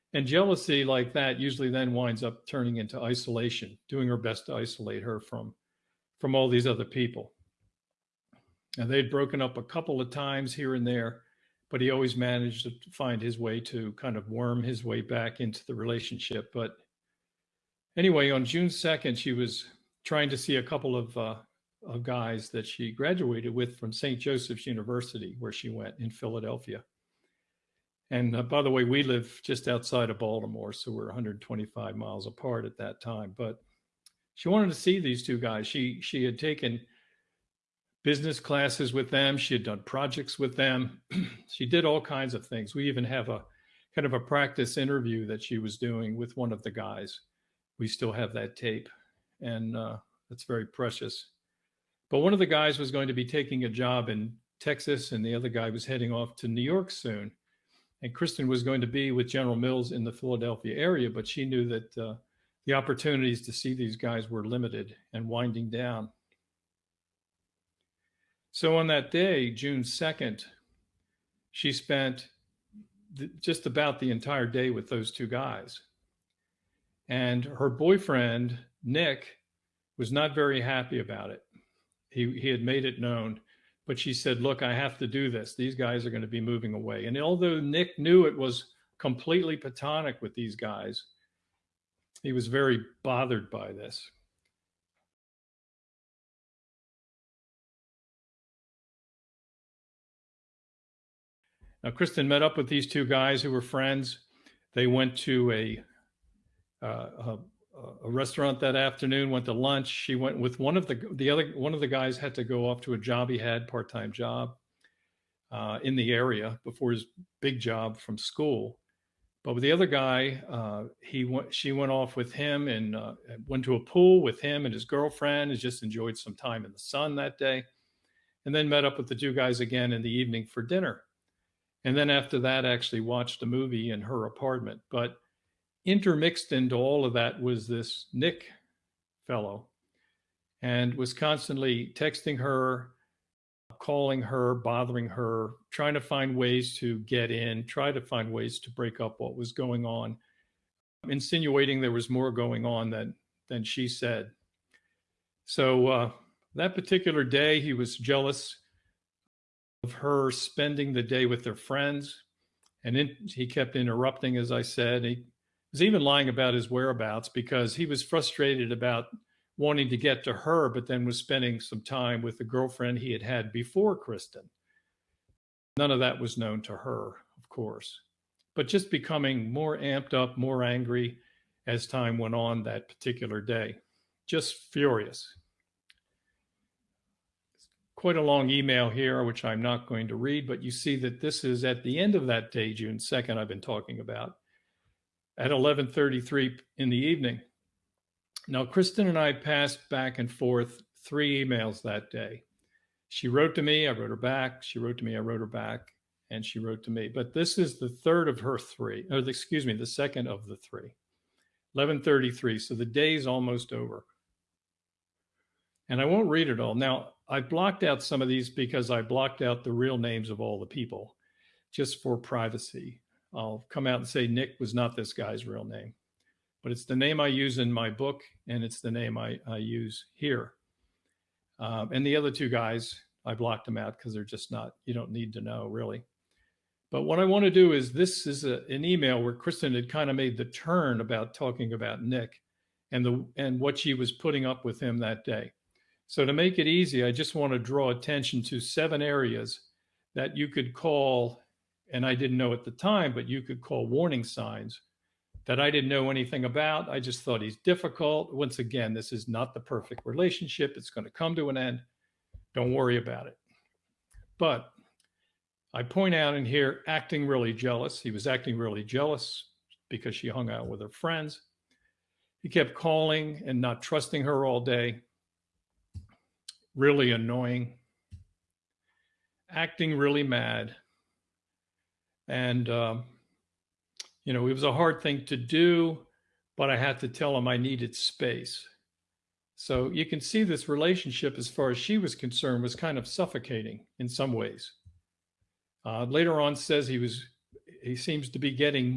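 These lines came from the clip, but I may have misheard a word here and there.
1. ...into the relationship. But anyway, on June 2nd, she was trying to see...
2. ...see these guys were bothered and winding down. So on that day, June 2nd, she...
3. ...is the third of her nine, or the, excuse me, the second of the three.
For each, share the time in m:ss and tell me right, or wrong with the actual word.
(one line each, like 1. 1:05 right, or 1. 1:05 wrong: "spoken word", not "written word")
1. 0:15 right
2. 1:03 wrong: "limited", not "bothered"
3. 3:27 wrong: "three", not "nine".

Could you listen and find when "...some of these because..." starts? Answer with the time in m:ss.
3:38.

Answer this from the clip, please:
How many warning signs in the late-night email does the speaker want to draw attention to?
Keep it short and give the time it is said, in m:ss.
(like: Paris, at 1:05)
7, at 4:08.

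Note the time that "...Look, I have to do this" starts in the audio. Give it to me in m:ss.
1:24.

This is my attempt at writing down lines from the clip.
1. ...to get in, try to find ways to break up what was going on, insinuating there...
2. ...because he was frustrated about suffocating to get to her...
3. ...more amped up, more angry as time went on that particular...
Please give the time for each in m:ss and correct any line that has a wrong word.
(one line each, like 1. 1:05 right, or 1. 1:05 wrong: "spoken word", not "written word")
1. 2:26 right
2. 2:47 wrong: "wanting", not "suffocating"
3. 2:59 right.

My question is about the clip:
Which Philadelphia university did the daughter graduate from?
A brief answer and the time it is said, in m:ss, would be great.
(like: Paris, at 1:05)
St. Joseph's University, at 0:23.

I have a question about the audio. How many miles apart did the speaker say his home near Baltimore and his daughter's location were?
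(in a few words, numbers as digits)
125.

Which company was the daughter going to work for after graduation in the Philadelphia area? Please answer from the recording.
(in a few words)
General Mills.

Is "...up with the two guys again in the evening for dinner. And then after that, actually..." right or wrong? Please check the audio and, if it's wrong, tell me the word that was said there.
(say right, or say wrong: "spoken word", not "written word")
right.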